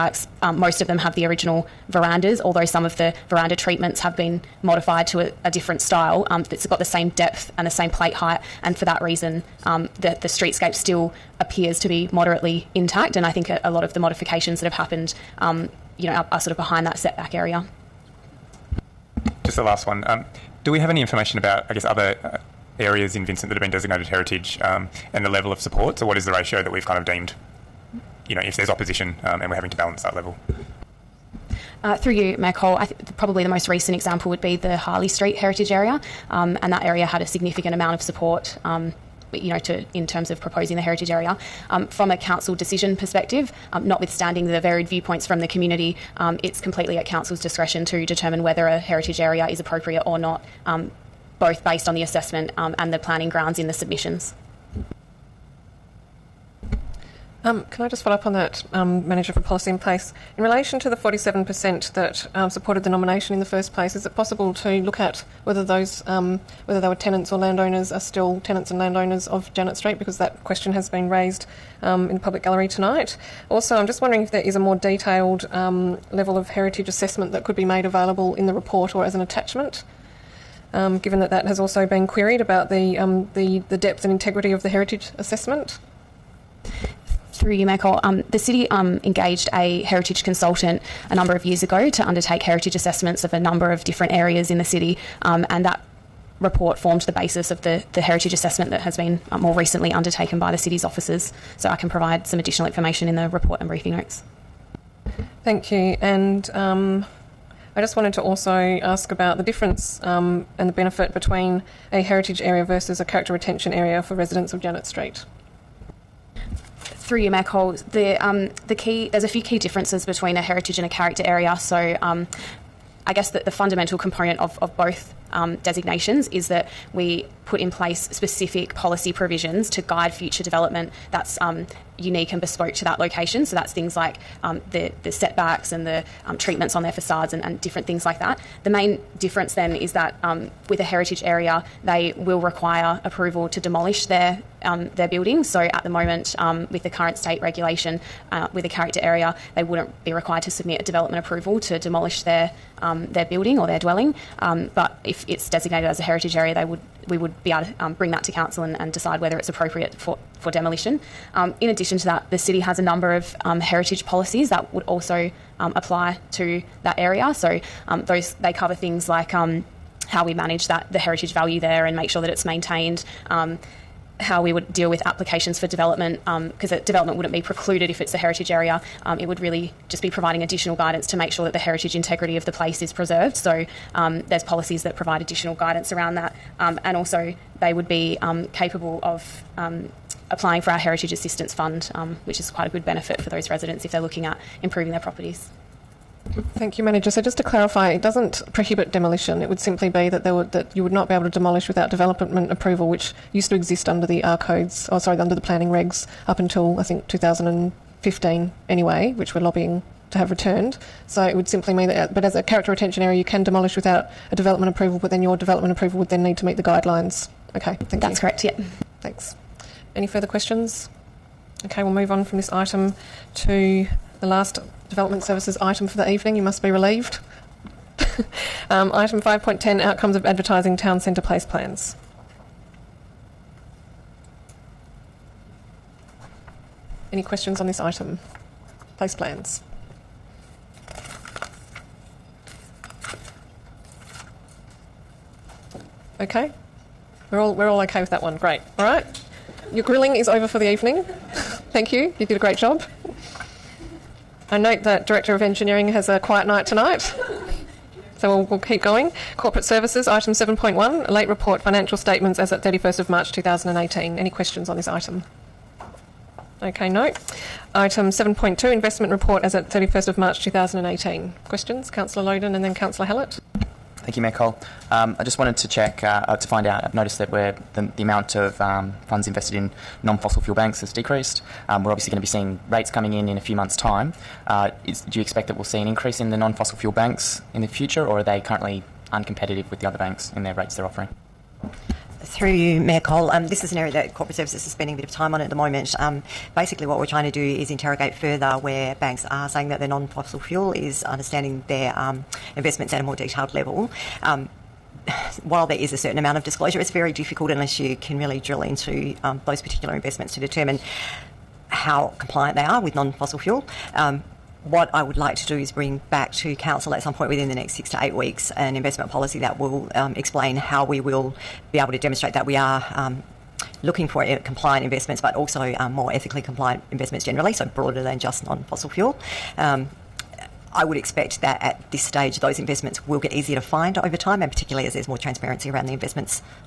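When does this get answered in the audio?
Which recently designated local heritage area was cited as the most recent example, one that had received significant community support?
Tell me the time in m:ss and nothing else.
0:34.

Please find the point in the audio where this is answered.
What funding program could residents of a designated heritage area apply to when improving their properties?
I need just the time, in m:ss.
3:10.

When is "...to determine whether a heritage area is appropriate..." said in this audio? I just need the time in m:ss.
0:47.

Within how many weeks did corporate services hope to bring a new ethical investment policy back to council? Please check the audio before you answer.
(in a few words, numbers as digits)
6 to 8 weeks.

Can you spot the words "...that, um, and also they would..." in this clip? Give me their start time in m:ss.
3:06.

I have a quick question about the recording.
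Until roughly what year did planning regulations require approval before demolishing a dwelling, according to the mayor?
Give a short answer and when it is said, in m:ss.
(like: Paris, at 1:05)
2015, at 3:27.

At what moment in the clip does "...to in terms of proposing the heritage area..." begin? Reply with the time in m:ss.
0:39.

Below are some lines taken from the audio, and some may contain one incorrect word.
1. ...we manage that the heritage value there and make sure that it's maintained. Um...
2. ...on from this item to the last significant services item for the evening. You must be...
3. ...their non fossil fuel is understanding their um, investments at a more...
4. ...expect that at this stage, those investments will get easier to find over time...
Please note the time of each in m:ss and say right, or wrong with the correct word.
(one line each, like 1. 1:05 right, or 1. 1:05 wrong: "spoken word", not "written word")
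1. 2:50 right
2. 3:42 wrong: "development", not "significant"
3. 4:59 right
4. 5:30 right.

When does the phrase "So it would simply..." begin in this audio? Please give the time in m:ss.
3:31.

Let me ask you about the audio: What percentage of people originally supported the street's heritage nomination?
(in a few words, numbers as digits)
47%.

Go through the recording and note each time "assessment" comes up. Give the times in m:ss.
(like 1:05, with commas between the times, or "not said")
0:52, 1:16, 1:25, 1:32, 1:38.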